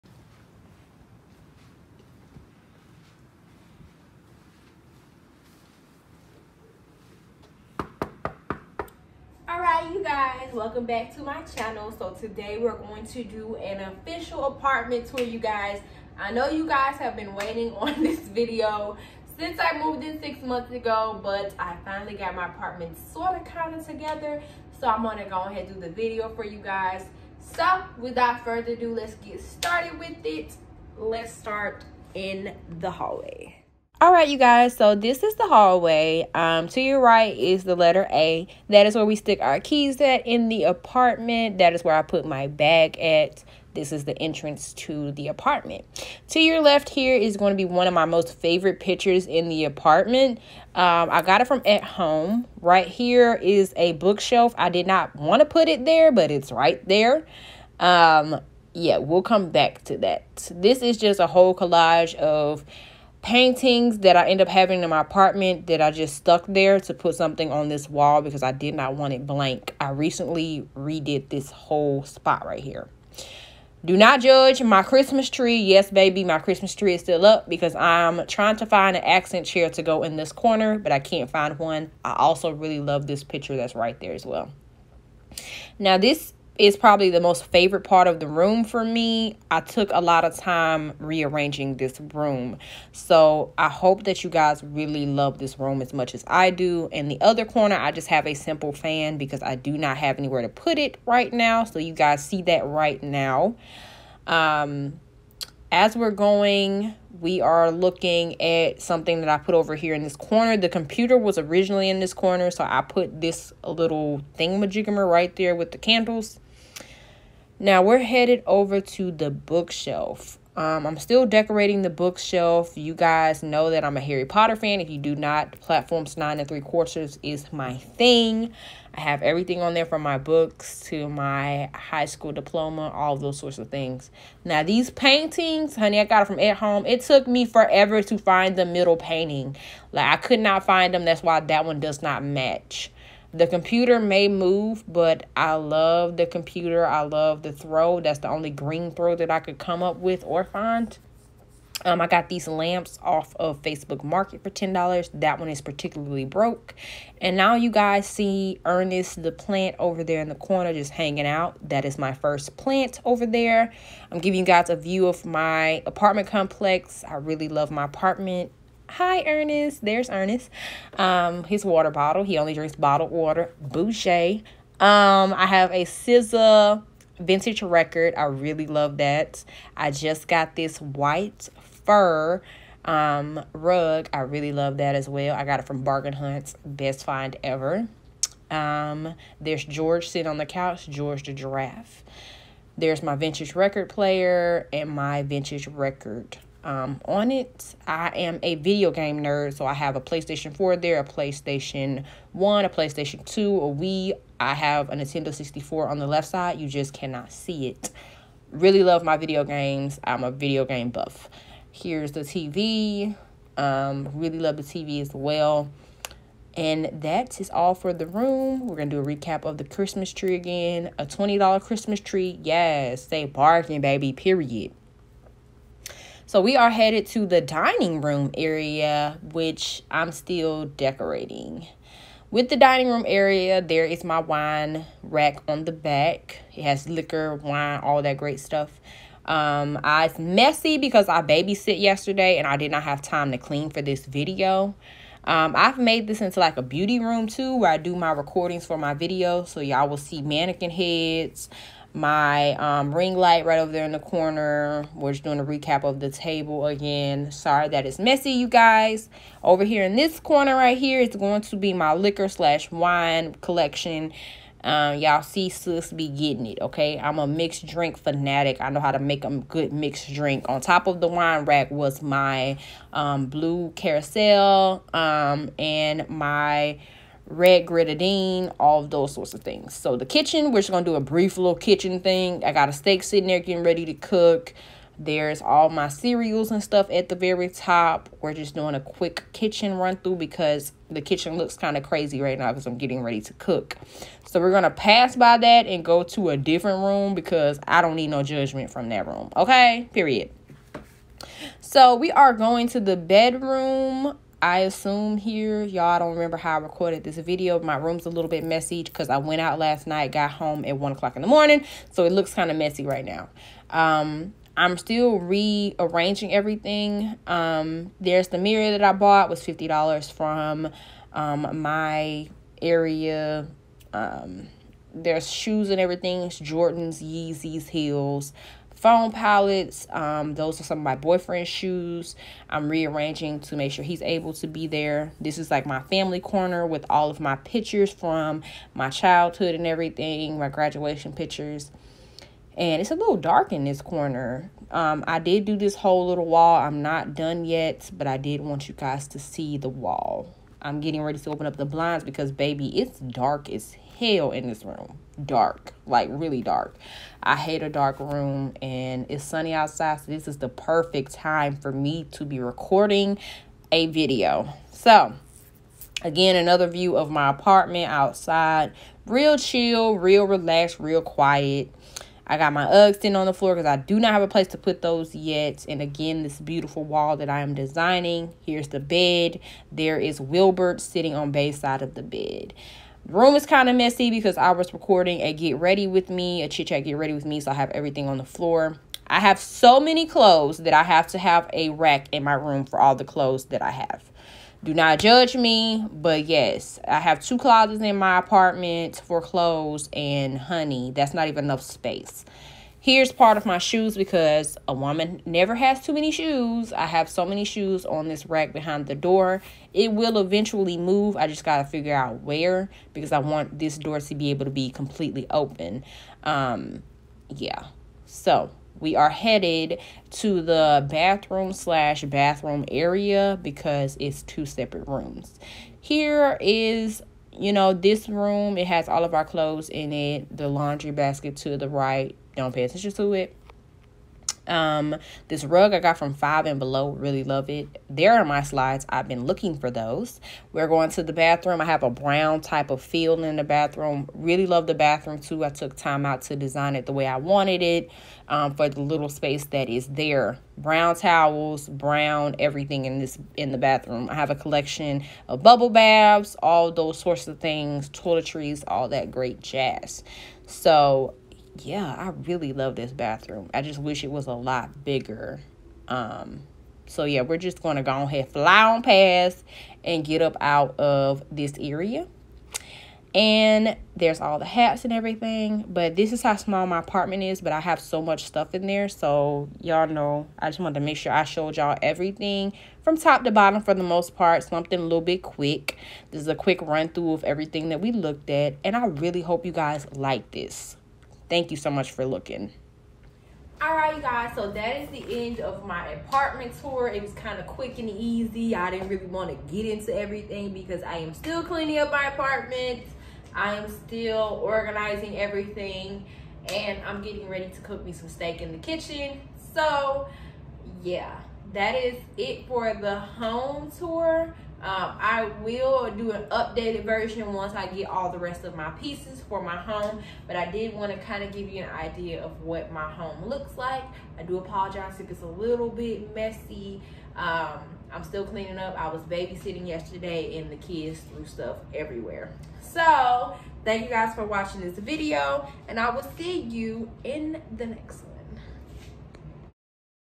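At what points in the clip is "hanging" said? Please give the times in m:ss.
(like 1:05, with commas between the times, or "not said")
2:40.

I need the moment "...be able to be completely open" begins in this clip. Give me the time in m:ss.
6:54.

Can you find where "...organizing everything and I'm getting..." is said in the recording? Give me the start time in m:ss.
8:24.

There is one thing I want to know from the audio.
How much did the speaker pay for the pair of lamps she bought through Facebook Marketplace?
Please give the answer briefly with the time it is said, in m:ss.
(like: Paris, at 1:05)
$10, at 2:34.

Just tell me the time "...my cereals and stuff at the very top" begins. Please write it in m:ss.
4:45.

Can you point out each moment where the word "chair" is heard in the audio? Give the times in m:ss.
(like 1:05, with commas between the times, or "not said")
1:19.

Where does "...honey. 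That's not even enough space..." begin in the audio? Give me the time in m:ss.
6:40.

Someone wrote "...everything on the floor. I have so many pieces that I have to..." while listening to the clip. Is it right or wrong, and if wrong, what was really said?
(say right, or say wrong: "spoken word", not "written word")
wrong: "clothes", not "pieces".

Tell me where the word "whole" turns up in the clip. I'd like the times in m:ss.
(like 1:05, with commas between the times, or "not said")
1:01, 1:11, 5:45.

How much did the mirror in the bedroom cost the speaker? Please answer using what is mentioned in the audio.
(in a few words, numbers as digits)
$50.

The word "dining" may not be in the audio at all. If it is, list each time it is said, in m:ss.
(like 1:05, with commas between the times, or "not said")
3:47, 3:52.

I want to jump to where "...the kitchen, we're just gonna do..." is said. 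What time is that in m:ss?
4:39.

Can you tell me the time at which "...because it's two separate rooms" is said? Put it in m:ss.
7:03.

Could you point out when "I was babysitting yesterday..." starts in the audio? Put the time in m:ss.
8:48.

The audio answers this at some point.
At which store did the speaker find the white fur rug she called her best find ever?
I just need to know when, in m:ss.
3:05.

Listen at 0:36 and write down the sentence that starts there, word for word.
Um, to your right is the letter A.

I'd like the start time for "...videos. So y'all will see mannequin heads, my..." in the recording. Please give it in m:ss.
4:08.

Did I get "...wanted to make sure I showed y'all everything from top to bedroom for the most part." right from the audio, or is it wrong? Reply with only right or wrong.
wrong.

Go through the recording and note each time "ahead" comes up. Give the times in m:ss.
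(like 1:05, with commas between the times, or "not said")
0:25, 7:48.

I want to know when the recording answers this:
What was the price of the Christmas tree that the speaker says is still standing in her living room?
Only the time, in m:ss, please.
3:41.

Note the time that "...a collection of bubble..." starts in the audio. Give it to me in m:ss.
7:34.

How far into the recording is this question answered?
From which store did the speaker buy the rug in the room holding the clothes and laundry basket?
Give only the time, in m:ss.
7:16.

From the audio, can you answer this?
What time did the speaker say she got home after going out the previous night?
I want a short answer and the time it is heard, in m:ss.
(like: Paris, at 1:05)
1 o'clock, at 5:10.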